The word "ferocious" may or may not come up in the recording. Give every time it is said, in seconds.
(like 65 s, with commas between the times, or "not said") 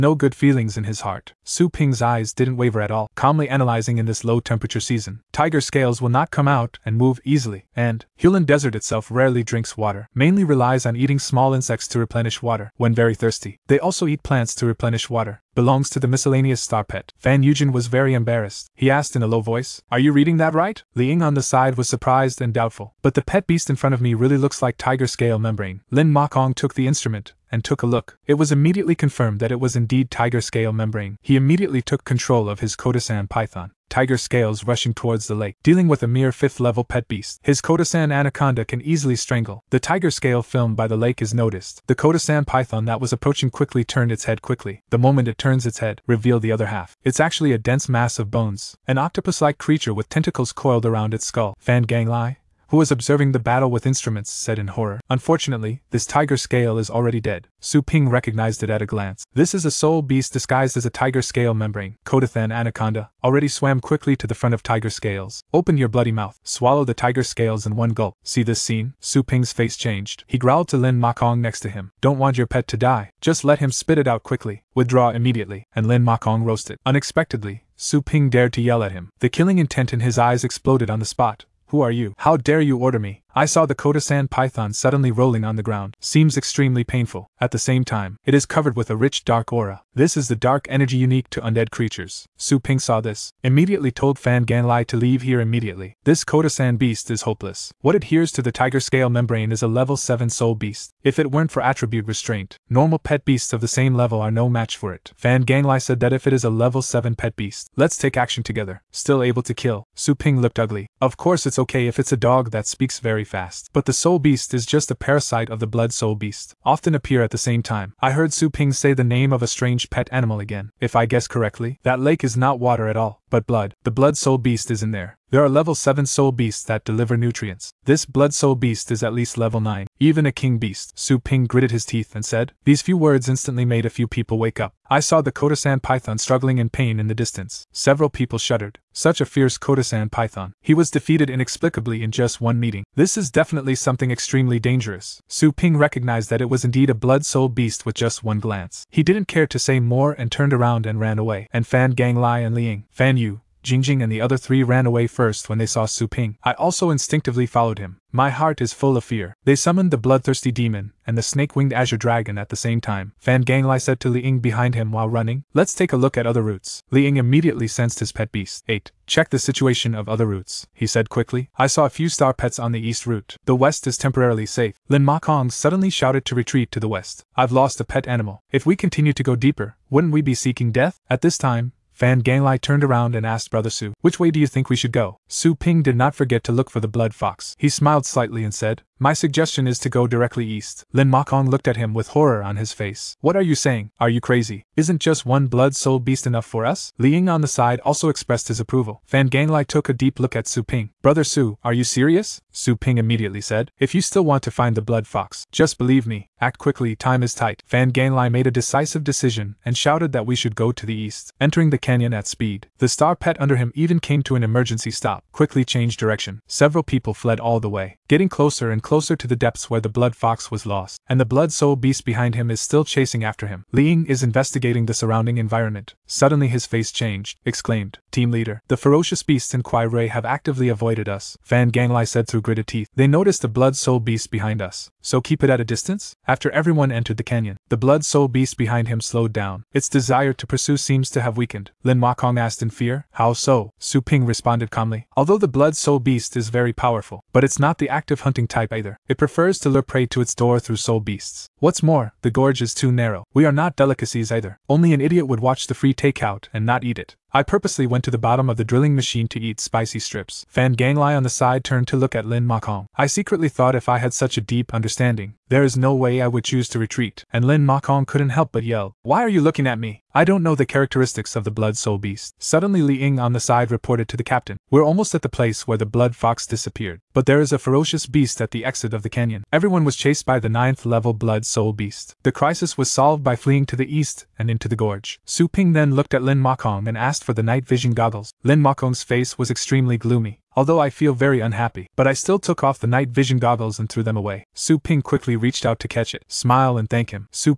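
228 s, 277 s.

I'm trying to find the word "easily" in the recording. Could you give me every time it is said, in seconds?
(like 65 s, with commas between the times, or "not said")
7 s, 38 s.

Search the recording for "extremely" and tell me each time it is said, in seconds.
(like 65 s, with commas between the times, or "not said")
86 s, 144 s, 289 s.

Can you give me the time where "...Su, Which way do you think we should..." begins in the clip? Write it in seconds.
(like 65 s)
183 s.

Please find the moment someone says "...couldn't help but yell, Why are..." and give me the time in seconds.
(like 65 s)
268 s.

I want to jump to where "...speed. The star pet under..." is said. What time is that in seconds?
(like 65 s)
212 s.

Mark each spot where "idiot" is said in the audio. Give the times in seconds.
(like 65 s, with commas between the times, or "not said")
255 s.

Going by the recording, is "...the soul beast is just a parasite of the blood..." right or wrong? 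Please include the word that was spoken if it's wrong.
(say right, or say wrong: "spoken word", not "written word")
right.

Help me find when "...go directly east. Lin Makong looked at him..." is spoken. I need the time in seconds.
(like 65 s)
189 s.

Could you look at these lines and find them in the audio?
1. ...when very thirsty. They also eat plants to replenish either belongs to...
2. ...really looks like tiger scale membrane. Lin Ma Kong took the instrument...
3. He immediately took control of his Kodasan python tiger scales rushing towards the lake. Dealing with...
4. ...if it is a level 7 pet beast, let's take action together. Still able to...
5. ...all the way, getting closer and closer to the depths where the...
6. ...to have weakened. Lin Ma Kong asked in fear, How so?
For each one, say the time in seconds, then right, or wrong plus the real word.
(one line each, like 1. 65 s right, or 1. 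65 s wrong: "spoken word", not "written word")
1. 12 s wrong: "water", not "either"
2. 24 s right
3. 31 s right
4. 106 s right
5. 217 s right
6. 241 s right.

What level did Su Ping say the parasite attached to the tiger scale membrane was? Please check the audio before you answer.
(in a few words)
7.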